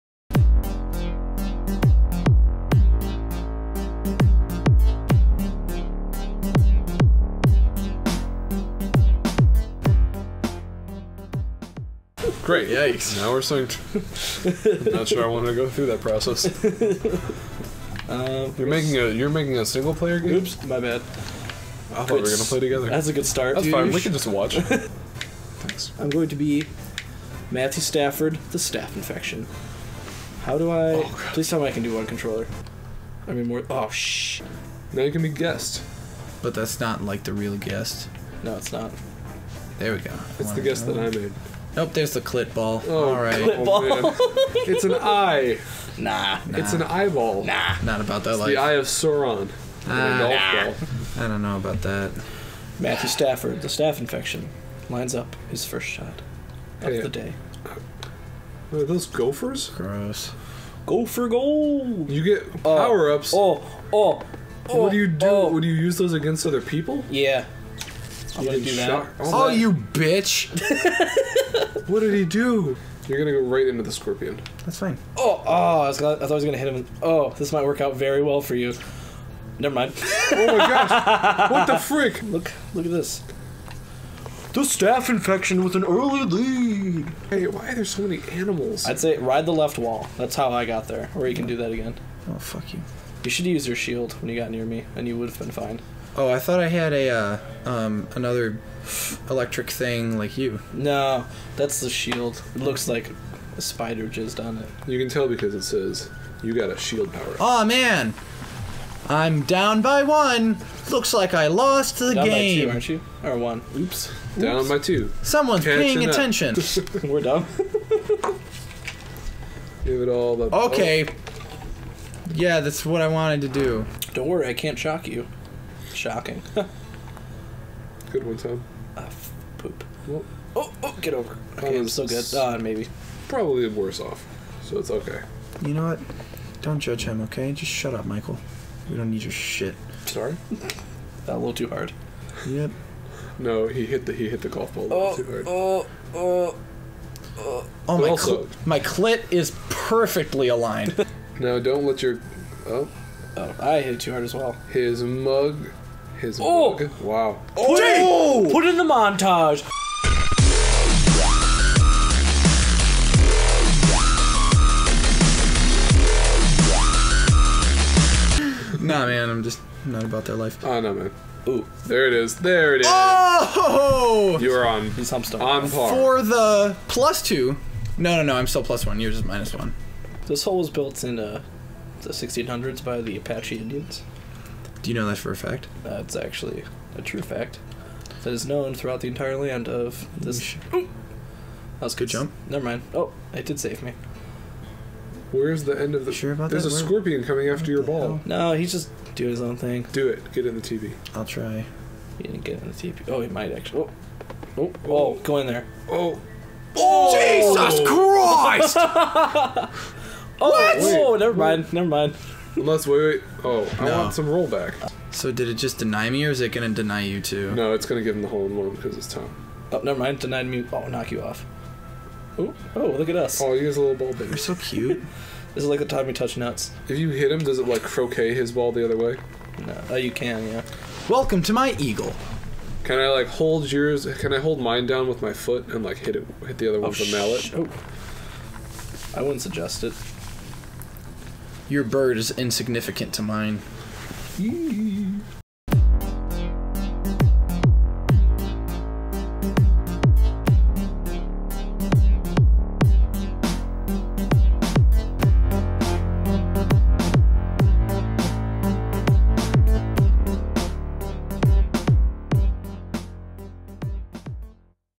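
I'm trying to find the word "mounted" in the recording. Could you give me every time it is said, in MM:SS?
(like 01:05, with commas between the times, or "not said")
not said.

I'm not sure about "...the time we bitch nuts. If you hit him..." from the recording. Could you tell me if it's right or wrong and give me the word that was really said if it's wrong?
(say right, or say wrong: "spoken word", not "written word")
wrong: "touch", not "bitch".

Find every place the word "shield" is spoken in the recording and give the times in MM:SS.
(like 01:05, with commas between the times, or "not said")
01:33, 01:41, 01:46.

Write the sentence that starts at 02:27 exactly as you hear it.
oh my, also, cl my clit is perfectly aligned.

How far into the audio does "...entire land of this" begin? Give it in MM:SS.
03:09.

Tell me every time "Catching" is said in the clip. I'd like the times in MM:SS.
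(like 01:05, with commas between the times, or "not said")
01:55.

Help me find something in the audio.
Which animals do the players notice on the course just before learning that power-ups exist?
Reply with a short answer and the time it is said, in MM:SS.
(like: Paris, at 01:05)
Gophers, at 00:59.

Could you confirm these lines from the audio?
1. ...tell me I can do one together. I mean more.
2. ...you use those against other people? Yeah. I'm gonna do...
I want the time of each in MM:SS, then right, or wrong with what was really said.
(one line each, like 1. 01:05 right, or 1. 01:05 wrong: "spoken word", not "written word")
1. 00:31 wrong: "controller", not "together"
2. 01:05 right.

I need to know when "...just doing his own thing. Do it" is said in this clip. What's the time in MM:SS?
03:18.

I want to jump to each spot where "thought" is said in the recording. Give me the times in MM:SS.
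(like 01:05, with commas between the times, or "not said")
00:20, 01:16, 01:36.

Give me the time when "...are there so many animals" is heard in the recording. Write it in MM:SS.
01:27.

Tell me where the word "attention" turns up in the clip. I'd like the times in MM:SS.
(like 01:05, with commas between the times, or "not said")
01:56.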